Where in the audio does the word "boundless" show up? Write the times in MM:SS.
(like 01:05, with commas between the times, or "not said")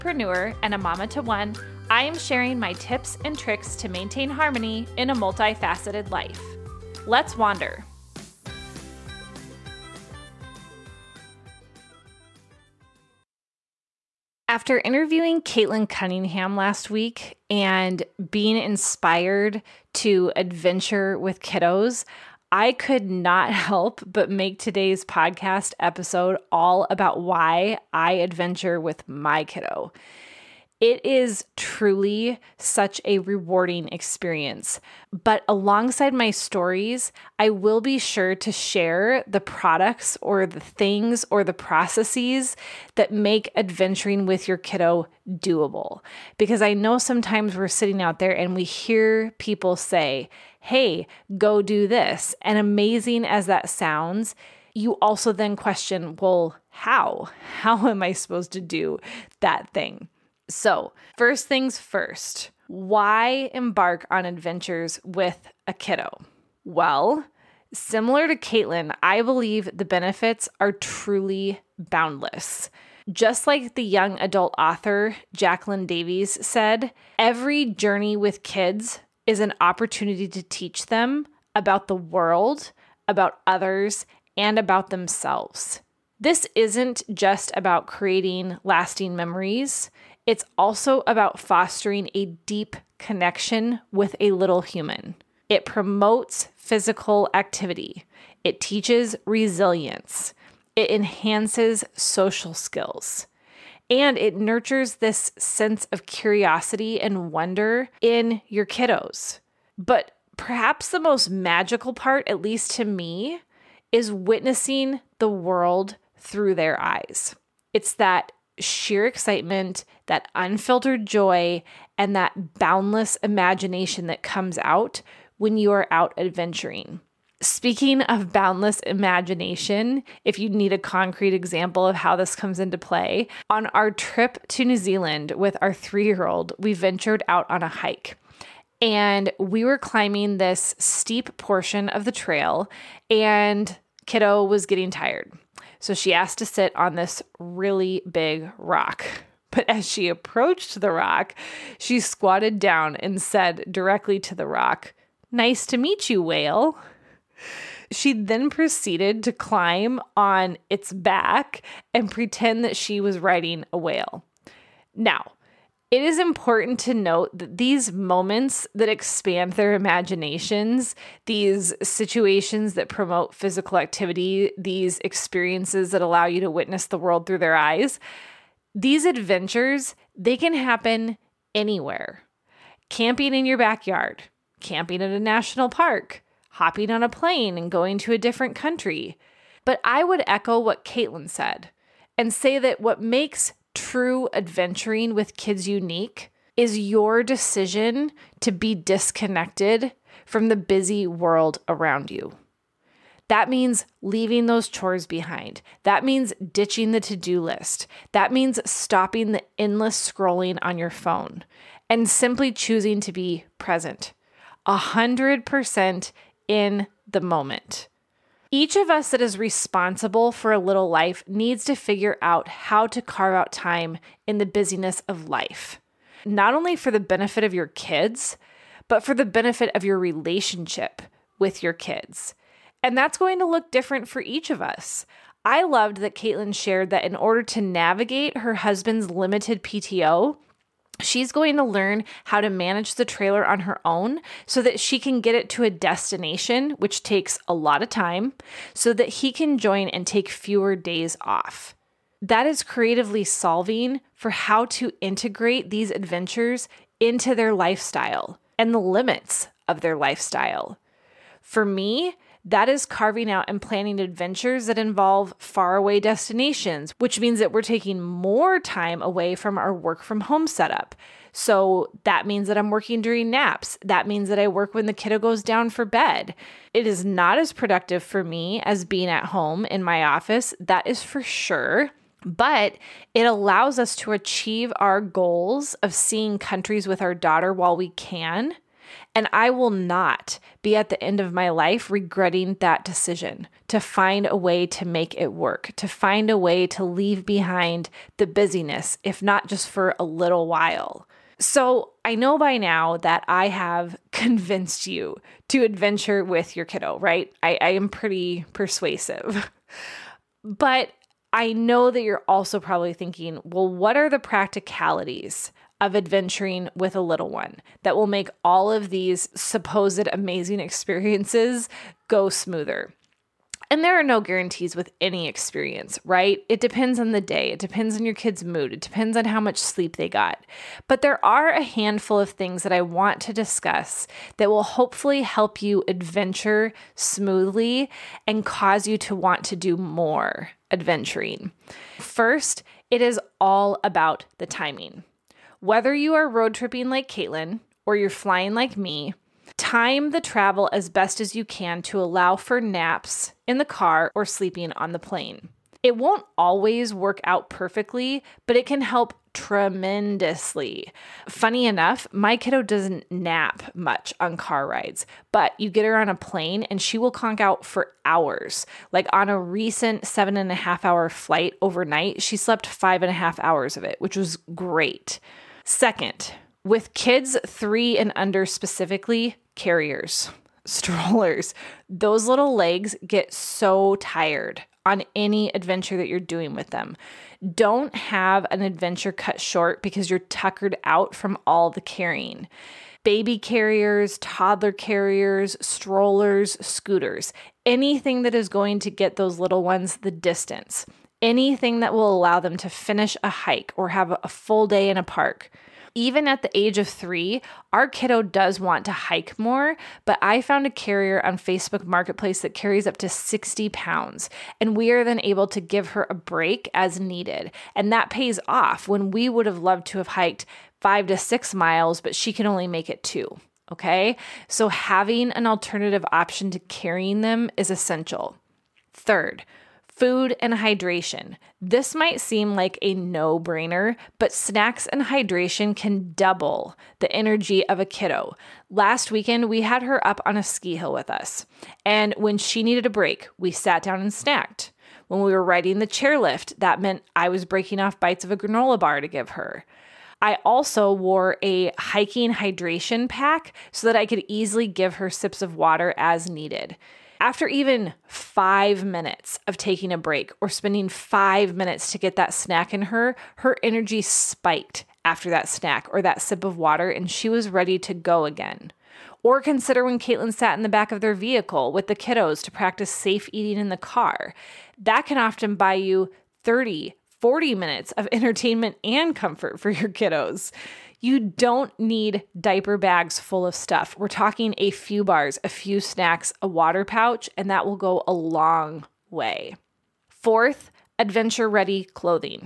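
01:11, 02:02, 02:08.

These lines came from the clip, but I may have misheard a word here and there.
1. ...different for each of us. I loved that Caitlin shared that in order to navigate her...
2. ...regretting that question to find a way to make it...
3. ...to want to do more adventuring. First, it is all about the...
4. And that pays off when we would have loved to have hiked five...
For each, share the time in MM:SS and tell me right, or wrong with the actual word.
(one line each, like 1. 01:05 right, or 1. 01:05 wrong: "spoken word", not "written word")
1. 03:53 right
2. 04:51 wrong: "decision", not "question"
3. 05:38 right
4. 06:57 right.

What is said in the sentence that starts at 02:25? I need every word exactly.
So she asked to sit on this really big rock.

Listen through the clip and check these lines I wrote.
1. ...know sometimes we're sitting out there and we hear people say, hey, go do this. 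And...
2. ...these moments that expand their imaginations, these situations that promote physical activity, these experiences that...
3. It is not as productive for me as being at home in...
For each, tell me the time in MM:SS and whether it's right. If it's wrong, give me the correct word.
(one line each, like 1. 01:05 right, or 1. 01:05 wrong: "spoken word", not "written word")
1. 00:46 right
2. 02:47 right
3. 04:36 right.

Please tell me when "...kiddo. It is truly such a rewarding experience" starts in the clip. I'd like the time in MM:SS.
00:29.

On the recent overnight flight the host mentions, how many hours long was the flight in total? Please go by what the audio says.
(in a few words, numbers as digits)
7.5.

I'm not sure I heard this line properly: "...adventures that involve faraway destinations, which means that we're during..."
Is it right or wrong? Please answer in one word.
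wrong.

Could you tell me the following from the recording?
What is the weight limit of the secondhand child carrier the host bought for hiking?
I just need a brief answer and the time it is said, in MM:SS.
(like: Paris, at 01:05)
60 pounds, at 06:53.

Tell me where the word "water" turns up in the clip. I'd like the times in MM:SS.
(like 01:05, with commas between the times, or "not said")
07:35, 07:46, 08:06.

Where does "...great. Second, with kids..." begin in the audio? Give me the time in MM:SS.
06:14.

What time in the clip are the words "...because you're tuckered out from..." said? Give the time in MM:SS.
06:29.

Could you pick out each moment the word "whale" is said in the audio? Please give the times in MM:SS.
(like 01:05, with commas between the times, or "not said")
02:36, 02:43.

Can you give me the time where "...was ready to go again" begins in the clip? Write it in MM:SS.
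07:47.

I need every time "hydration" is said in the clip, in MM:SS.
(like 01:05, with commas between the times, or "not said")
07:10, 07:15, 07:32.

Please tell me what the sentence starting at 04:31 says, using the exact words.
So that means that I'm working during naps.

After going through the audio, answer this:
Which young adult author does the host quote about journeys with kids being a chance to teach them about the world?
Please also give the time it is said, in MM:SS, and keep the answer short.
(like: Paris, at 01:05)
Jacqueline Davies, at 01:15.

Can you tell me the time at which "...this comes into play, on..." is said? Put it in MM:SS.
02:12.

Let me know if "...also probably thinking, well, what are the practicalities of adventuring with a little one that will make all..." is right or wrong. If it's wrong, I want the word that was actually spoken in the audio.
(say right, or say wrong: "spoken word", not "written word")
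right.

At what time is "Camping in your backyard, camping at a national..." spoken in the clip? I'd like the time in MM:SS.
03:02.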